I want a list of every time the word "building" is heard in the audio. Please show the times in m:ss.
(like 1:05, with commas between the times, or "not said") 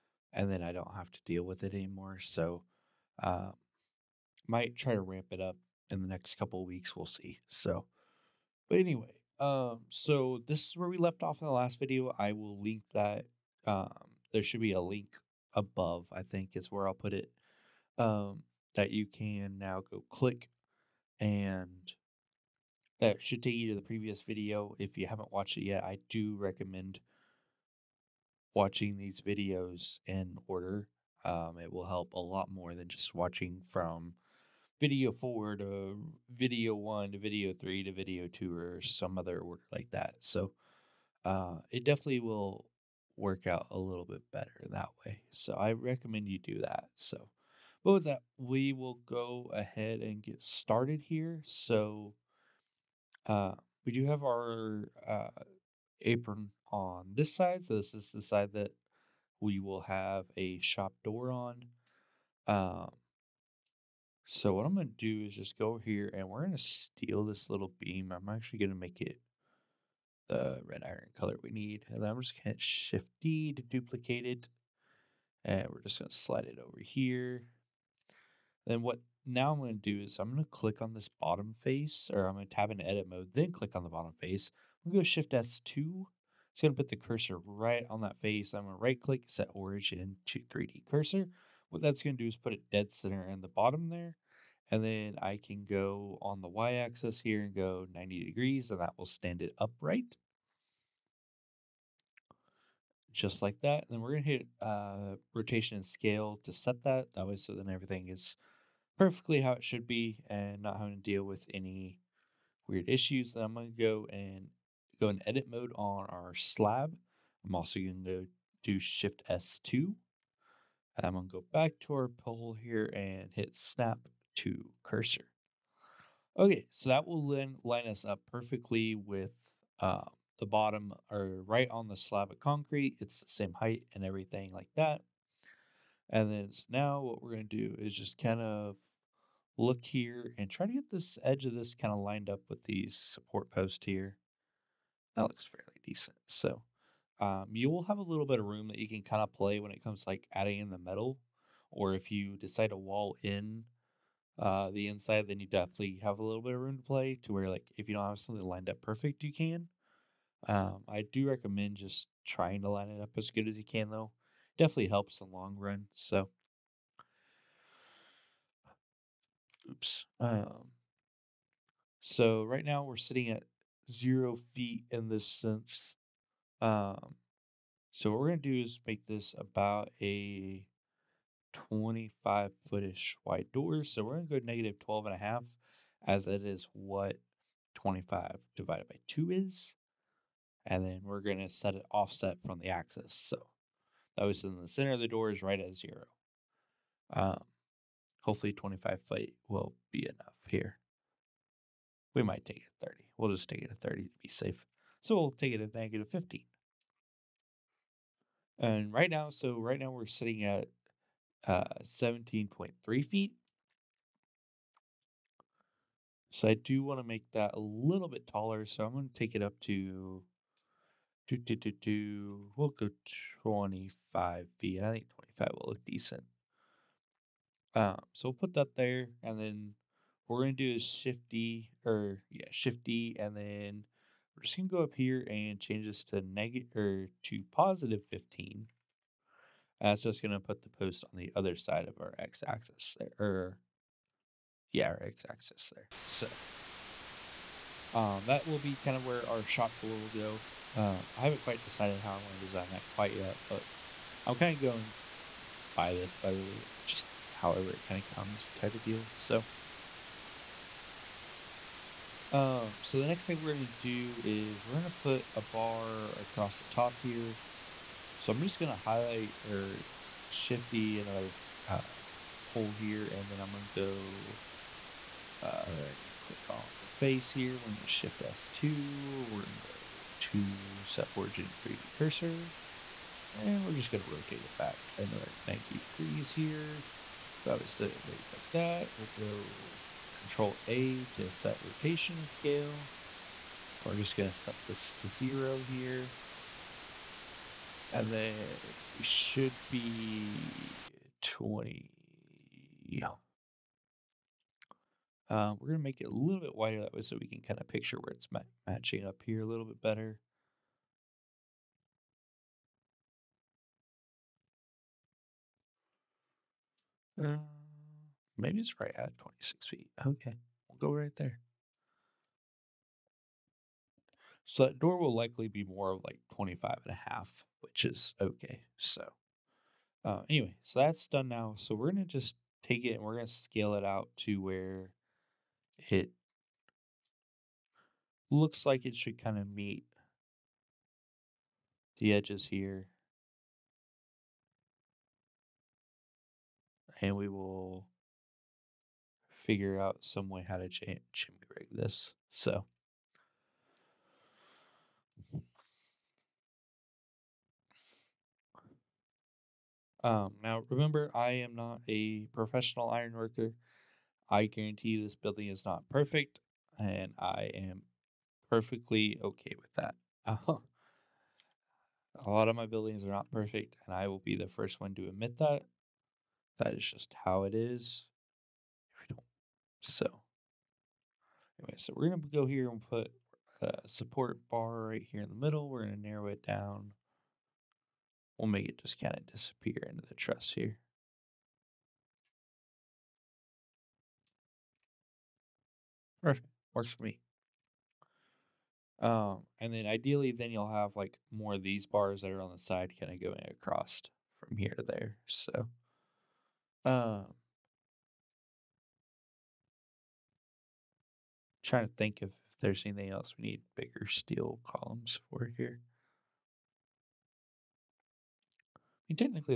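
6:05, 6:12.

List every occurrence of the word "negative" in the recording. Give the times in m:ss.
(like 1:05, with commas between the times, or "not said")
3:04, 3:25, 3:56.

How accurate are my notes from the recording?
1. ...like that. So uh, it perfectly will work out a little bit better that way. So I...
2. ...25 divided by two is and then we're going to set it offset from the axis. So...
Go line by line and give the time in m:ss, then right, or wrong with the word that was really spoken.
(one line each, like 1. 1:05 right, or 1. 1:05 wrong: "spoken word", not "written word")
1. 0:39 wrong: "definitely", not "perfectly"
2. 3:07 right.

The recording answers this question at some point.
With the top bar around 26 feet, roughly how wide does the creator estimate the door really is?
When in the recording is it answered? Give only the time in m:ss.
5:26.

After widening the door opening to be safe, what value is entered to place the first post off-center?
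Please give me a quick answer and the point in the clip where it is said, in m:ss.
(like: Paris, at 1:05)
-15, at 3:25.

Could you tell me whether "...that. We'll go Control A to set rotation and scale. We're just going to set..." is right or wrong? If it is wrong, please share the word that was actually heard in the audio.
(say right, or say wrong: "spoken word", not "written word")
right.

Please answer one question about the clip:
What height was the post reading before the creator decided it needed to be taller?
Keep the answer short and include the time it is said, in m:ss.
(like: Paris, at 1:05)
17.3 feet, at 3:31.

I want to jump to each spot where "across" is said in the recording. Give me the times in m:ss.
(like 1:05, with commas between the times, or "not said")
4:26, 6:43.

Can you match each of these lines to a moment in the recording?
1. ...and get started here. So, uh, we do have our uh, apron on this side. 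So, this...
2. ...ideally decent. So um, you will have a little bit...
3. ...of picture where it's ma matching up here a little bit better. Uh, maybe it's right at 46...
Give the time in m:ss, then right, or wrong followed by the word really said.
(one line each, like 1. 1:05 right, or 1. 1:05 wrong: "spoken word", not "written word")
1. 0:49 right
2. 2:25 wrong: "fairly", not "ideally"
3. 5:07 wrong: "26", not "46".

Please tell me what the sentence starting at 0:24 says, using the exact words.
If you haven't watched it yet, I do recommend watching these videos in order.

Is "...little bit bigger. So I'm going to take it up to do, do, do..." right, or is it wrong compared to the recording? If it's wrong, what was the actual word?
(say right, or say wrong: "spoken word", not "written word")
wrong: "taller", not "bigger".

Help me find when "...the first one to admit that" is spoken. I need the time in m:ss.
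6:14.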